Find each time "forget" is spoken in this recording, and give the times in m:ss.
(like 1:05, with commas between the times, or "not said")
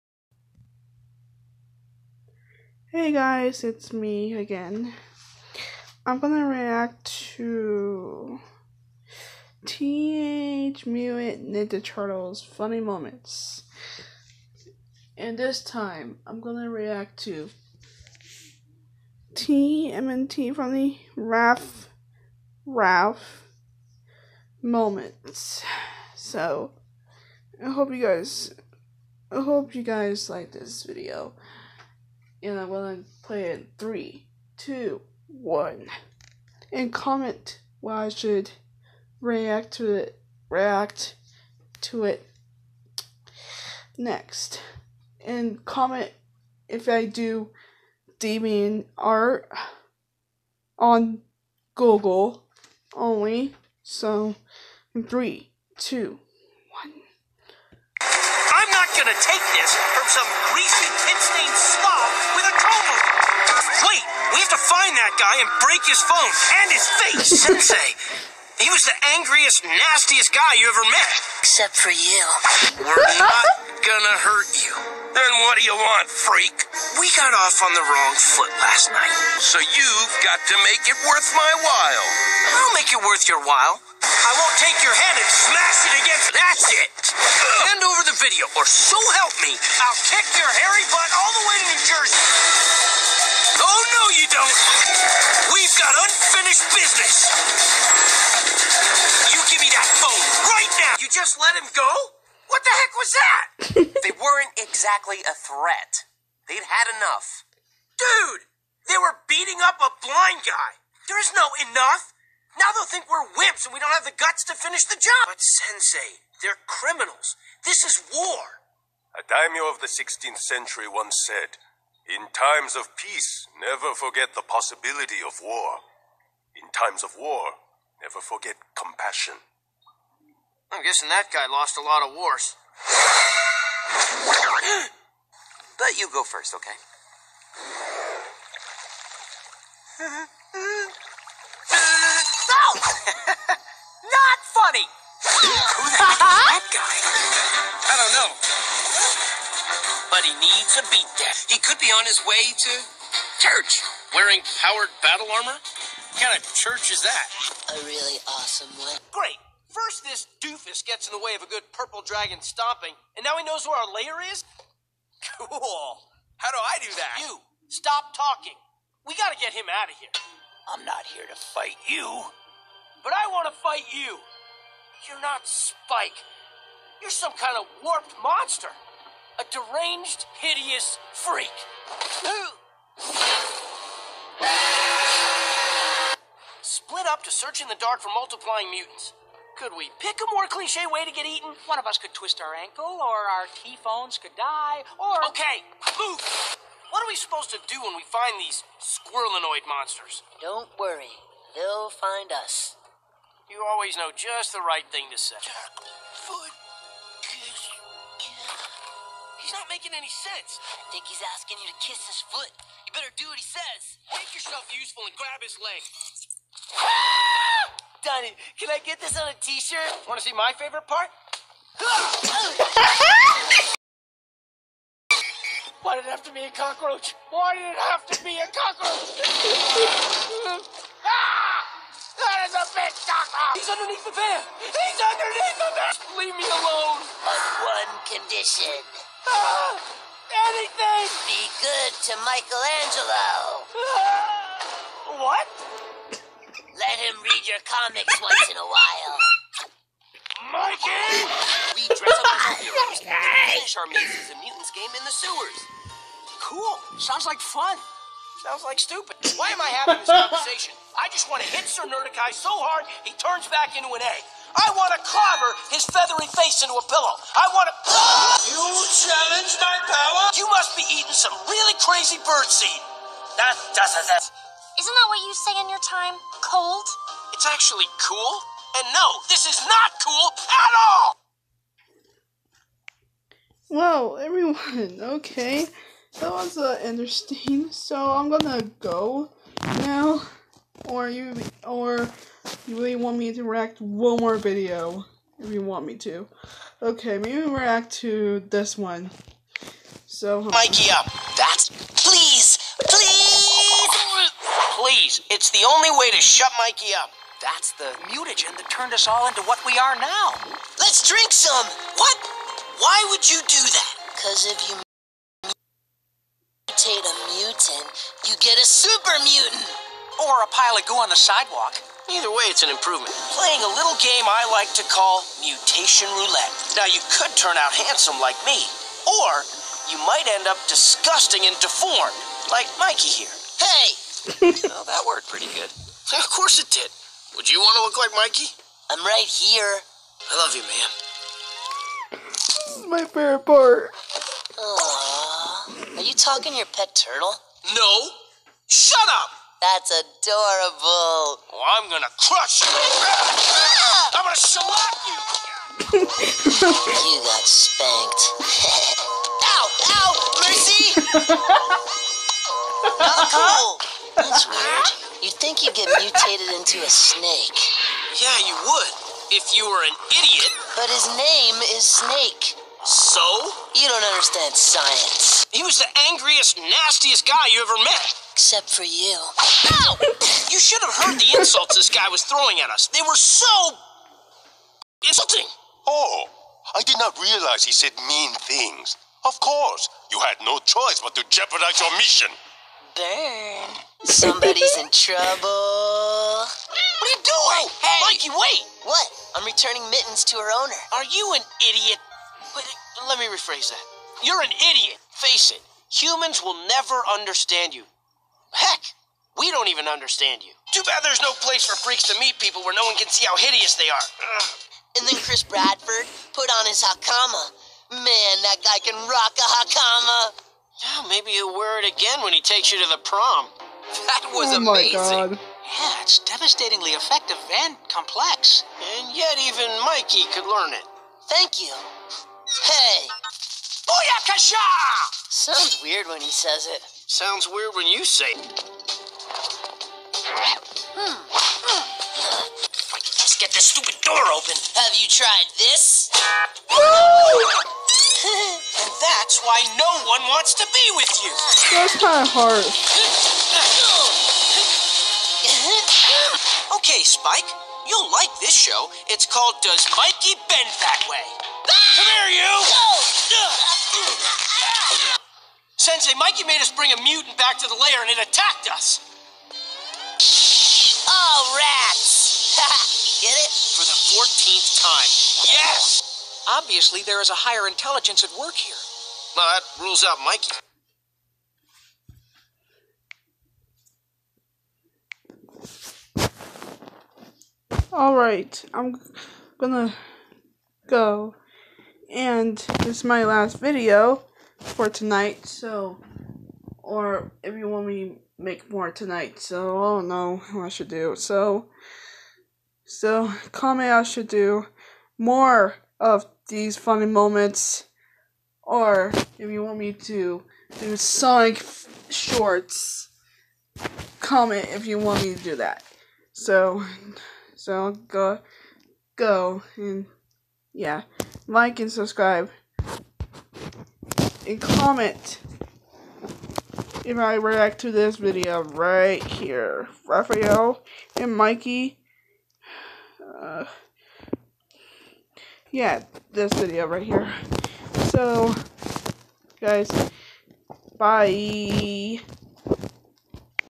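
2:03, 2:08.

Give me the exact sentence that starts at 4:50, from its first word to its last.
Or you, or you really want me to react one more video if you want me to.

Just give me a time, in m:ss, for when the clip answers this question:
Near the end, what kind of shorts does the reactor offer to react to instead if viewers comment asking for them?
8:30.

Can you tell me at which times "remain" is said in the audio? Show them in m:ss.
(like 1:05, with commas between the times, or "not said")
not said.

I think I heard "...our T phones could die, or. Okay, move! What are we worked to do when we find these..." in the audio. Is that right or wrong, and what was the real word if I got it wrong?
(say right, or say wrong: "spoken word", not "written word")
wrong: "supposed", not "worked".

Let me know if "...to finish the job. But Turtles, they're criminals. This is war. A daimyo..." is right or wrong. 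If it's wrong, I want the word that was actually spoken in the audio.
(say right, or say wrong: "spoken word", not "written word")
wrong: "Sensei", not "Turtles".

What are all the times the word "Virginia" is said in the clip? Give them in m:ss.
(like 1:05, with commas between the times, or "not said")
not said.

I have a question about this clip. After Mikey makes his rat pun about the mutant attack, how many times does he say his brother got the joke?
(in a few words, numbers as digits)
14.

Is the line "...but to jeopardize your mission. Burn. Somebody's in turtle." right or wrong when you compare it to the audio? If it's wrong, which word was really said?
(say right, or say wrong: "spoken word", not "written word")
wrong: "trouble", not "turtle".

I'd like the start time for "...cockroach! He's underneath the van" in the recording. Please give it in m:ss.
3:52.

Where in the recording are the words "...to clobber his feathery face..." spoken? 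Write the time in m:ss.
4:24.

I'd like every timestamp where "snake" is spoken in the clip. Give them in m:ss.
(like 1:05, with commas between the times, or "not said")
6:06, 6:11.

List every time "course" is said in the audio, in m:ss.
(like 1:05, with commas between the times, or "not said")
5:36, 6:29.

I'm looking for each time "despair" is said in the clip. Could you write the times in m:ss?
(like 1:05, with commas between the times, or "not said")
not said.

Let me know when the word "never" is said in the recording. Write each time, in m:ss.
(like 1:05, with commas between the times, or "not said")
2:03, 2:08, 6:46.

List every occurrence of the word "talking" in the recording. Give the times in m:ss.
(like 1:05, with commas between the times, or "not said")
2:48, 5:46.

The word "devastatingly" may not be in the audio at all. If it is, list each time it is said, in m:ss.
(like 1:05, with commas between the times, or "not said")
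7:06.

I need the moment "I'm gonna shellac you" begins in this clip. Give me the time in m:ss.
5:54.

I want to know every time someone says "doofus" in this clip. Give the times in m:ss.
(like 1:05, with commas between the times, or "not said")
2:40.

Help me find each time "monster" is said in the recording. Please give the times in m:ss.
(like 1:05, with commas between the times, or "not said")
2:58, 3:19.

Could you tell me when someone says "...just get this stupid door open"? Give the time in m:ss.
7:23.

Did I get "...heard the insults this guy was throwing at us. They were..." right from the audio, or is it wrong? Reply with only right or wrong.
right.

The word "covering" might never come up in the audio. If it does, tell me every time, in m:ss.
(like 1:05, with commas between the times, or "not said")
not said.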